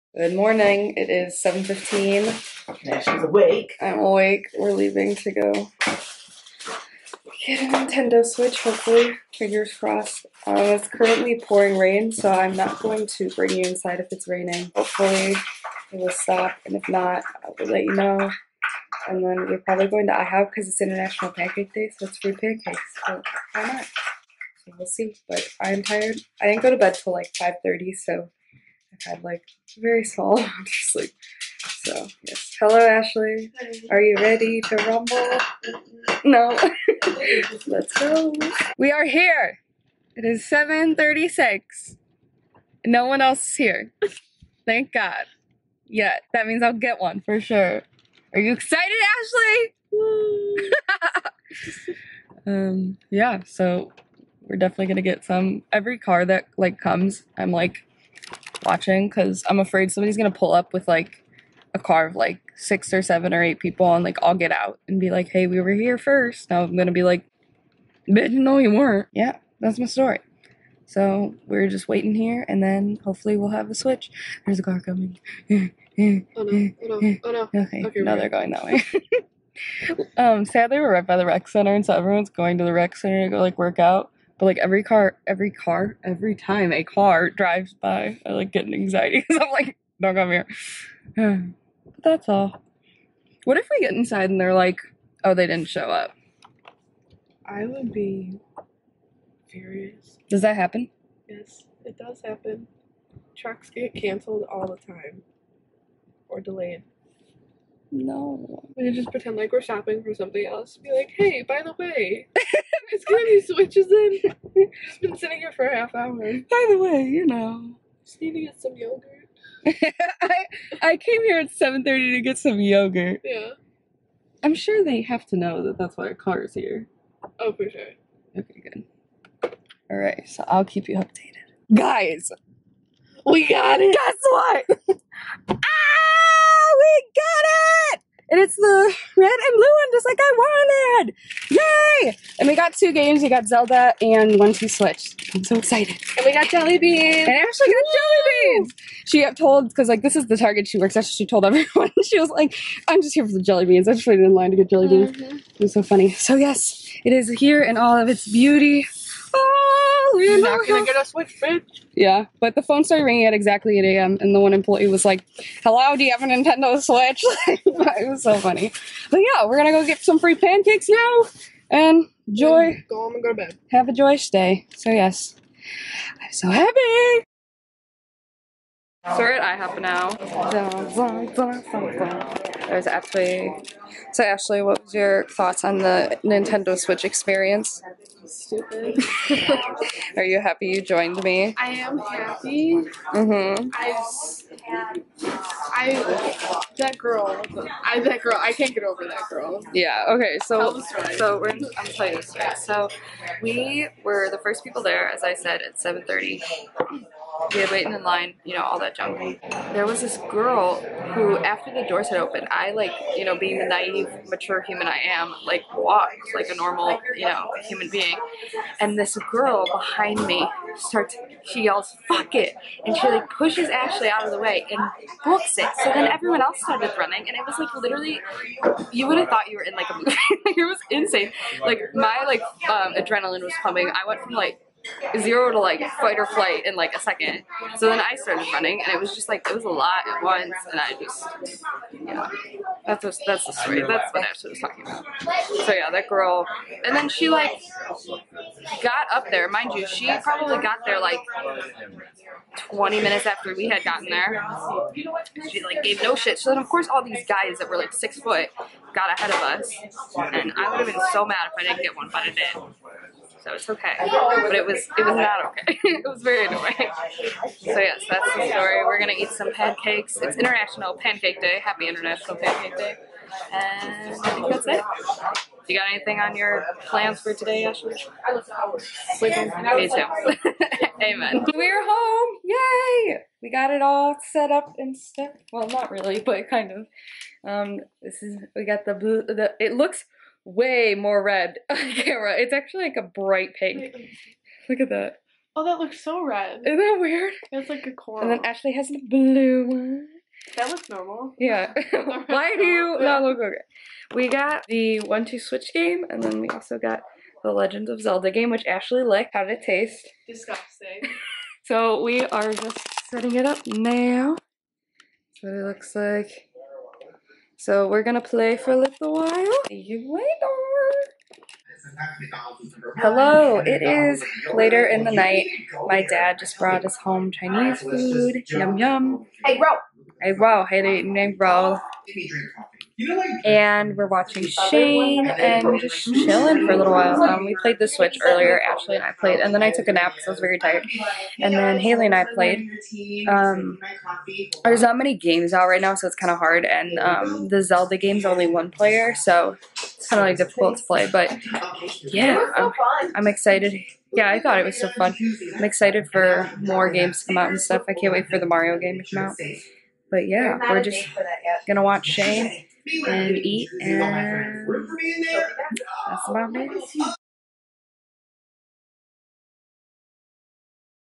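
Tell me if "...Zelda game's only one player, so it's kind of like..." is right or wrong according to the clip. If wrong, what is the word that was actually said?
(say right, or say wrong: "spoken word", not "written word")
right.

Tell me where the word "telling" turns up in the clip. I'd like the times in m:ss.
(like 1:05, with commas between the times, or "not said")
not said.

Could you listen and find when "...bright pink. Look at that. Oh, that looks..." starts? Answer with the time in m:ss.
4:53.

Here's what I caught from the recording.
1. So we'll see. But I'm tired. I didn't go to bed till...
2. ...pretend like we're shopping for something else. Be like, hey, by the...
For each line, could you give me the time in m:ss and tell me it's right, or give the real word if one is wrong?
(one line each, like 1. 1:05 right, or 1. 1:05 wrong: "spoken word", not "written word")
1. 0:24 right
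2. 1:49 right.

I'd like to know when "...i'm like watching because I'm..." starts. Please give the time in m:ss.
0:57.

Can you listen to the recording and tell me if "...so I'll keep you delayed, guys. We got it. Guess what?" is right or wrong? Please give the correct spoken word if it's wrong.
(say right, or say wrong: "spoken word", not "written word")
wrong: "updated", not "delayed".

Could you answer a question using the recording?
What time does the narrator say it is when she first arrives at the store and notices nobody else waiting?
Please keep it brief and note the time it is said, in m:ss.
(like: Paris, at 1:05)
7:36, at 0:40.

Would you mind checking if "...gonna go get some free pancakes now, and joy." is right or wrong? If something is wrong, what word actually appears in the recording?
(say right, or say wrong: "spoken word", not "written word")
right.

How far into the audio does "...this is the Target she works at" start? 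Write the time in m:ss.
2:30.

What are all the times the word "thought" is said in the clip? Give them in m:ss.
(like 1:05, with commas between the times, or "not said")
3:05, 3:49, 5:54.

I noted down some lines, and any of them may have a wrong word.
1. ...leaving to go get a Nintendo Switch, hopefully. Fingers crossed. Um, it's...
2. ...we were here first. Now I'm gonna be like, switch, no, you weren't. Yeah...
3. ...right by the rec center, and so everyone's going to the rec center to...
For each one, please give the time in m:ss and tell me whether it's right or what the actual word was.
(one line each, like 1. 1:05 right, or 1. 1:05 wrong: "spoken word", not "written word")
1. 0:04 right
2. 1:05 wrong: "bitch", not "switch"
3. 1:20 right.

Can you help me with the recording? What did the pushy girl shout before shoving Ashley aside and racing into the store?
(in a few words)
Fuck it.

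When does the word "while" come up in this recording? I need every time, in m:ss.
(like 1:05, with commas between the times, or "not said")
5:19, 5:36.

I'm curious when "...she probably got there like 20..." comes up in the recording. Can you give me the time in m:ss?
4:09.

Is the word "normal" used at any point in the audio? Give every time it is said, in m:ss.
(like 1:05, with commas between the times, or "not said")
3:36, 5:00.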